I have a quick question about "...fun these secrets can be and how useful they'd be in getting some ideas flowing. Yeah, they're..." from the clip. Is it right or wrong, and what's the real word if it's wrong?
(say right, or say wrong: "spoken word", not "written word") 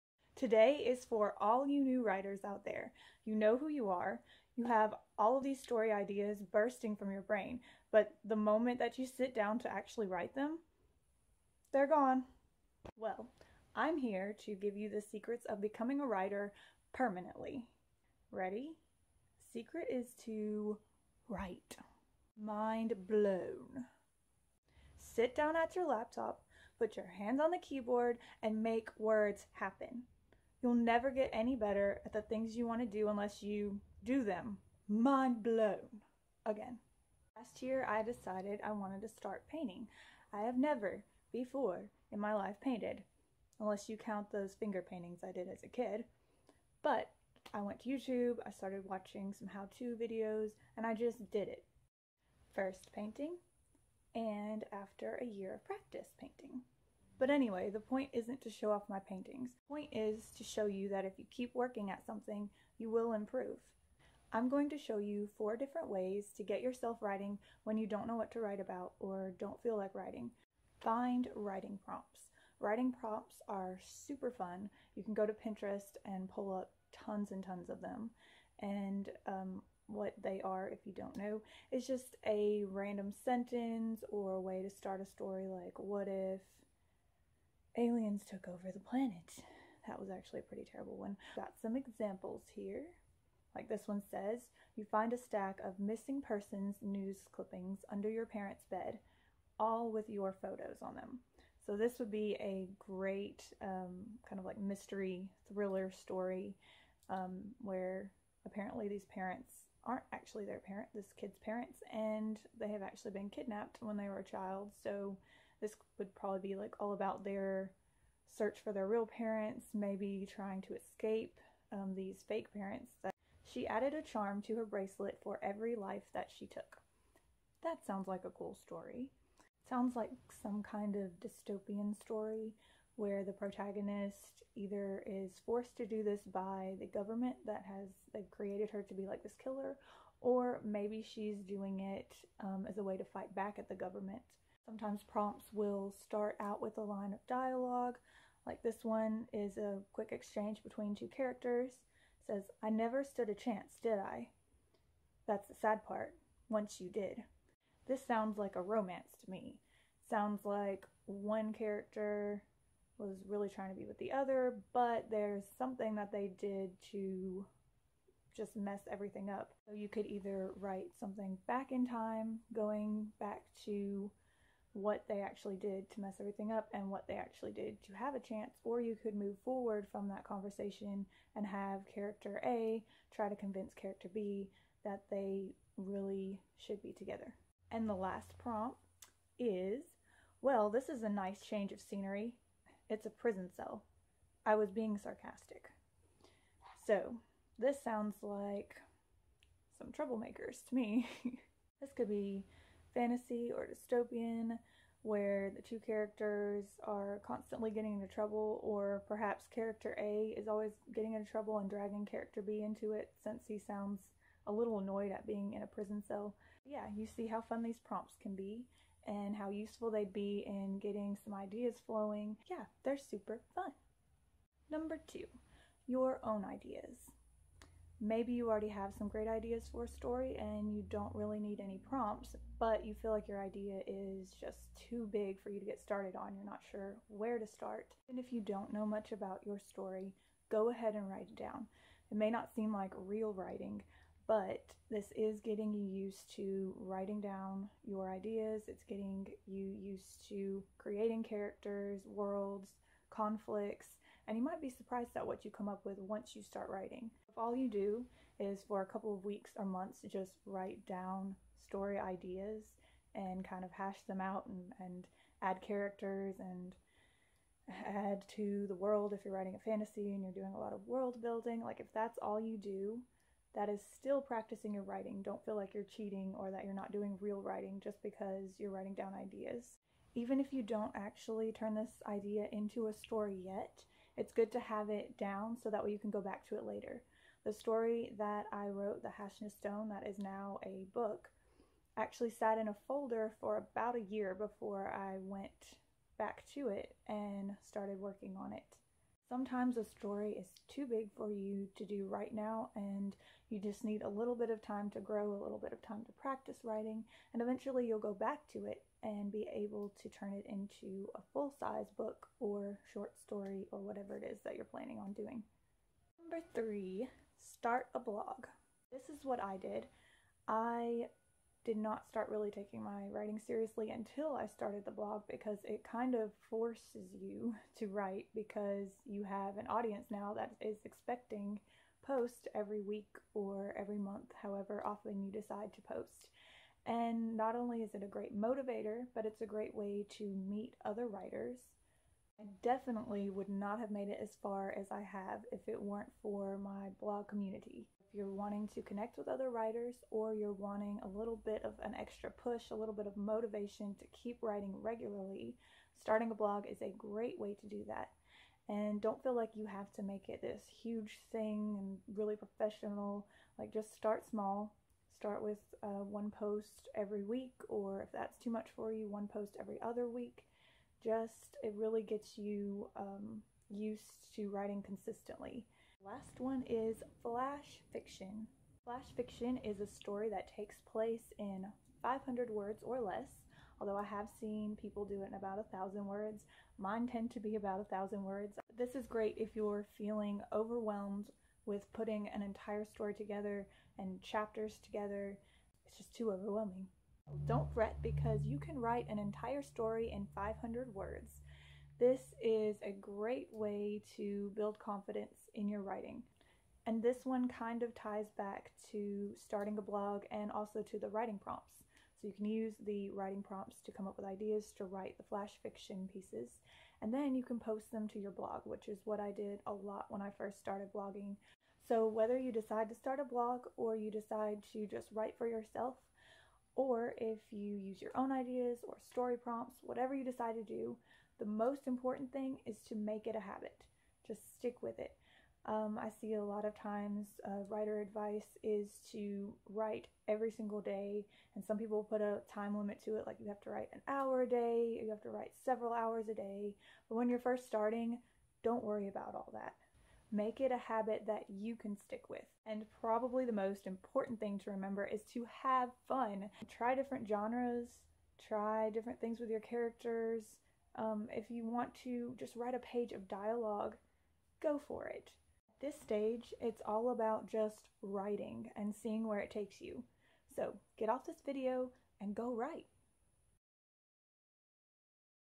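wrong: "prompts", not "secrets".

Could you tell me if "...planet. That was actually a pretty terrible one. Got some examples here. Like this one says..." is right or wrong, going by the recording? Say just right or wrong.
right.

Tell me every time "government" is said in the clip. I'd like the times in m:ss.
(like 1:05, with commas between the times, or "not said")
2:16, 2:23.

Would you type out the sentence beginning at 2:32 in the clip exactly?
It says, I never stood a chance, did I?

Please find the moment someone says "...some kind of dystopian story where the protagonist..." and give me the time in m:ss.
2:10.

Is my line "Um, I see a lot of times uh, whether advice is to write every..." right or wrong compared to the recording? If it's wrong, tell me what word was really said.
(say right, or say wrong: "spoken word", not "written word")
wrong: "writer", not "whether".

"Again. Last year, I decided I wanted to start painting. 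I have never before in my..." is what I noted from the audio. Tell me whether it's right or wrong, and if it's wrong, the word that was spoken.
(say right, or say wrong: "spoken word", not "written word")
right.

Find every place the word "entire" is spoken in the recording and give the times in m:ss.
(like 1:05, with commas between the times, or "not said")
6:32, 6:39.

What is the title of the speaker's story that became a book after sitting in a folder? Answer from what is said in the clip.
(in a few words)
The Hashness Stone.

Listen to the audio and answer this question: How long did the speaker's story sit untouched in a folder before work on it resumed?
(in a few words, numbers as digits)
About a year.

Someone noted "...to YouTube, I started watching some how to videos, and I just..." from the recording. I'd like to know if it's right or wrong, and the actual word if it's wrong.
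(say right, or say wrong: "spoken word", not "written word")
right.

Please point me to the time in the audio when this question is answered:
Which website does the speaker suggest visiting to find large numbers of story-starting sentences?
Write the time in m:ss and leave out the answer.
1:15.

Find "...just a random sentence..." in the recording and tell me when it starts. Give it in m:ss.
1:21.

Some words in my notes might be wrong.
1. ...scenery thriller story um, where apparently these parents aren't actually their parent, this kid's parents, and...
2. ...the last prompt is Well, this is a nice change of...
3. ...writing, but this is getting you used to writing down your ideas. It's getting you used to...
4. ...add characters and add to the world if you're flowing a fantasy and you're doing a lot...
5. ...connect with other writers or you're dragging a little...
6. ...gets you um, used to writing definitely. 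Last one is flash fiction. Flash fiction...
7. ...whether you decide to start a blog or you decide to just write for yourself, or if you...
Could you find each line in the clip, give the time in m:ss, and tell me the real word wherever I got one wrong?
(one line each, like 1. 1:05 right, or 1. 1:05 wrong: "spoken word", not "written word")
1. 1:44 wrong: "mystery", not "scenery"
2. 3:07 right
3. 4:03 right
4. 4:25 wrong: "writing", not "flowing"
5. 5:48 wrong: "wanting", not "dragging"
6. 6:12 wrong: "consistently", not "definitely"
7. 7:02 right.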